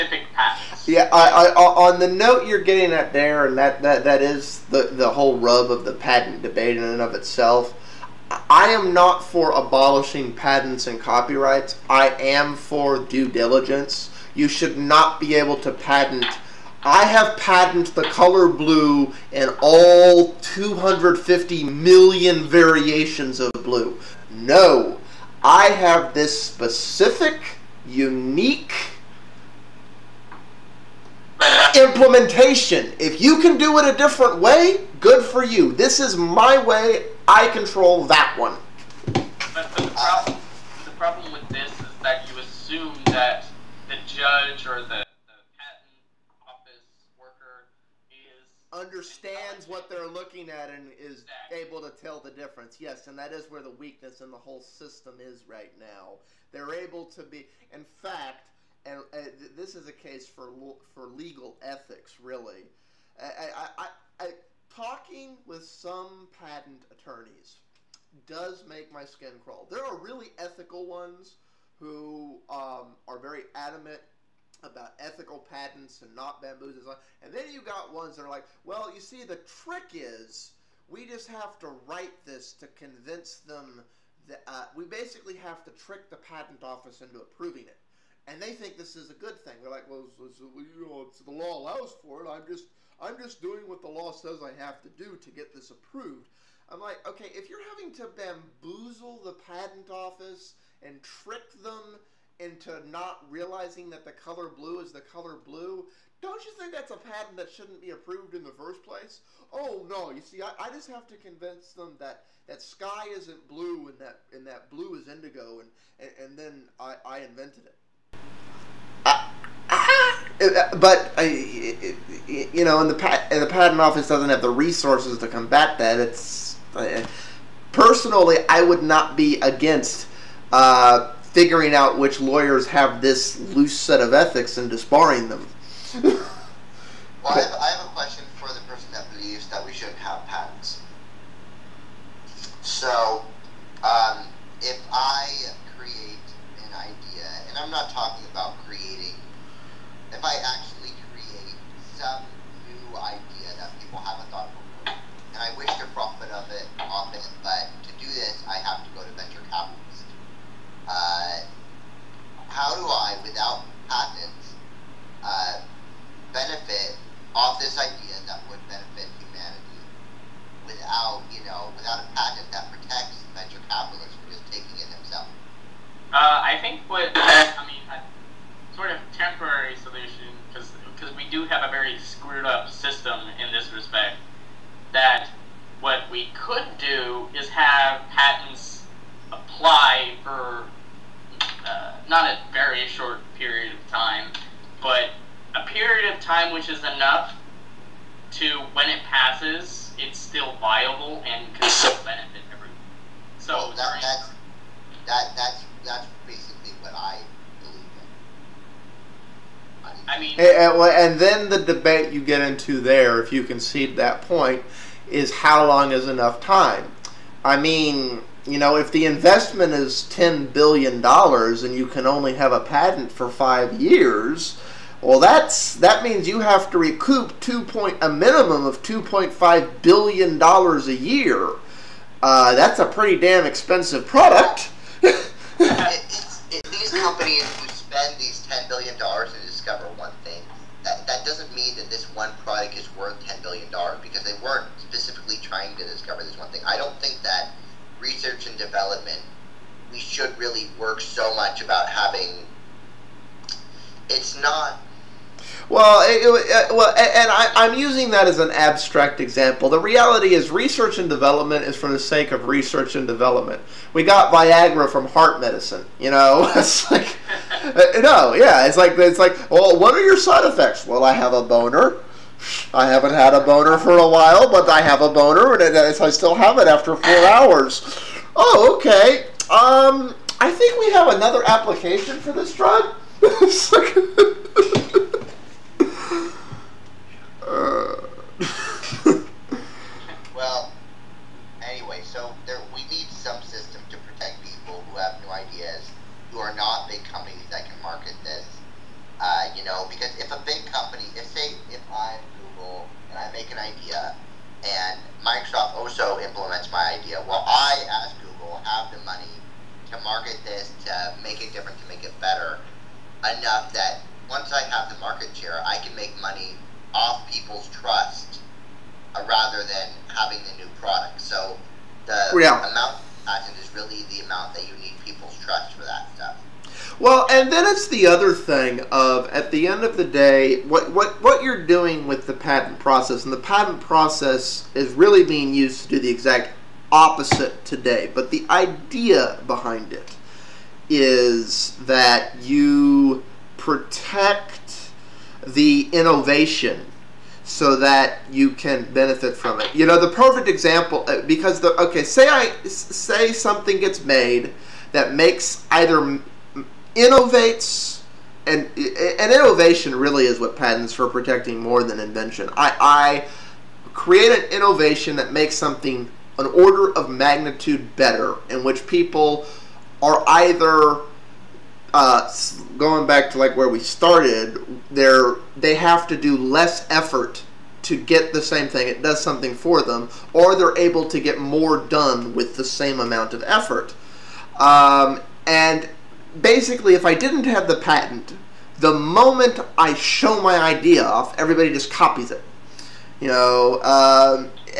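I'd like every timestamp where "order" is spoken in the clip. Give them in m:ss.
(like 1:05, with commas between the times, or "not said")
6:06.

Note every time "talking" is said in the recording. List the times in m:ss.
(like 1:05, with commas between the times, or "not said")
1:04, 2:27.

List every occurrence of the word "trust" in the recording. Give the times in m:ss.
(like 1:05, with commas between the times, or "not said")
5:17, 5:25.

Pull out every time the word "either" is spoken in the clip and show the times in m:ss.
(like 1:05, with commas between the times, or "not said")
5:55, 6:10.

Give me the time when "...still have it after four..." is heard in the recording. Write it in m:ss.
4:36.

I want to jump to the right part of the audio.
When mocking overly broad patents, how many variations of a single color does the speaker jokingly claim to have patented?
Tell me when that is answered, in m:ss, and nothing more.
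0:20.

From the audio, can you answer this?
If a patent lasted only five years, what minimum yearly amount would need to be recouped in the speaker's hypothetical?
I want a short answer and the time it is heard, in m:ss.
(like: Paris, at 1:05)
$2.5 billion, at 3:48.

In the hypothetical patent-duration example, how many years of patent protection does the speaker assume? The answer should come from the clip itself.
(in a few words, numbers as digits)
5 years.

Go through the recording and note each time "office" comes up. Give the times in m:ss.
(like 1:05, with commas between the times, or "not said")
0:46, 1:26, 1:39, 2:03.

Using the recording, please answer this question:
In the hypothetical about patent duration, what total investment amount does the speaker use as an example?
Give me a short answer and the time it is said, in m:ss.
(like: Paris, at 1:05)
$10 billion, at 3:40.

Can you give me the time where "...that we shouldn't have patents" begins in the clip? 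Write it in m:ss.
2:19.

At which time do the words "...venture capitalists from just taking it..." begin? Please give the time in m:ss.
2:53.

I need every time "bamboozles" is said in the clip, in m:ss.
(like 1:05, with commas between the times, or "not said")
1:16, 1:38.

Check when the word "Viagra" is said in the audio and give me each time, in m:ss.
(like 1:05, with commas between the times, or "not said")
4:24.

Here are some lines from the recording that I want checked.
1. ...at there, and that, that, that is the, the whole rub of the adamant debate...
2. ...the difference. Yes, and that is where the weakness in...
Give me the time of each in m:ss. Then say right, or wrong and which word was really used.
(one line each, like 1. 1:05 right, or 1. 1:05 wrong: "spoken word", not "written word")
1. 0:02 wrong: "patent", not "adamant"
2. 0:52 right.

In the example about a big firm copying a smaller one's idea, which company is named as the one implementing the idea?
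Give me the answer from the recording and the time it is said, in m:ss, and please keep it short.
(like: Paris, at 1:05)
Microsoft, at 5:05.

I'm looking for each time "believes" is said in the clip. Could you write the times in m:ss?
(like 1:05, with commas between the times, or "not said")
2:19, 3:27.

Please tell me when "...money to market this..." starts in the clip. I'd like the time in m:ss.
5:09.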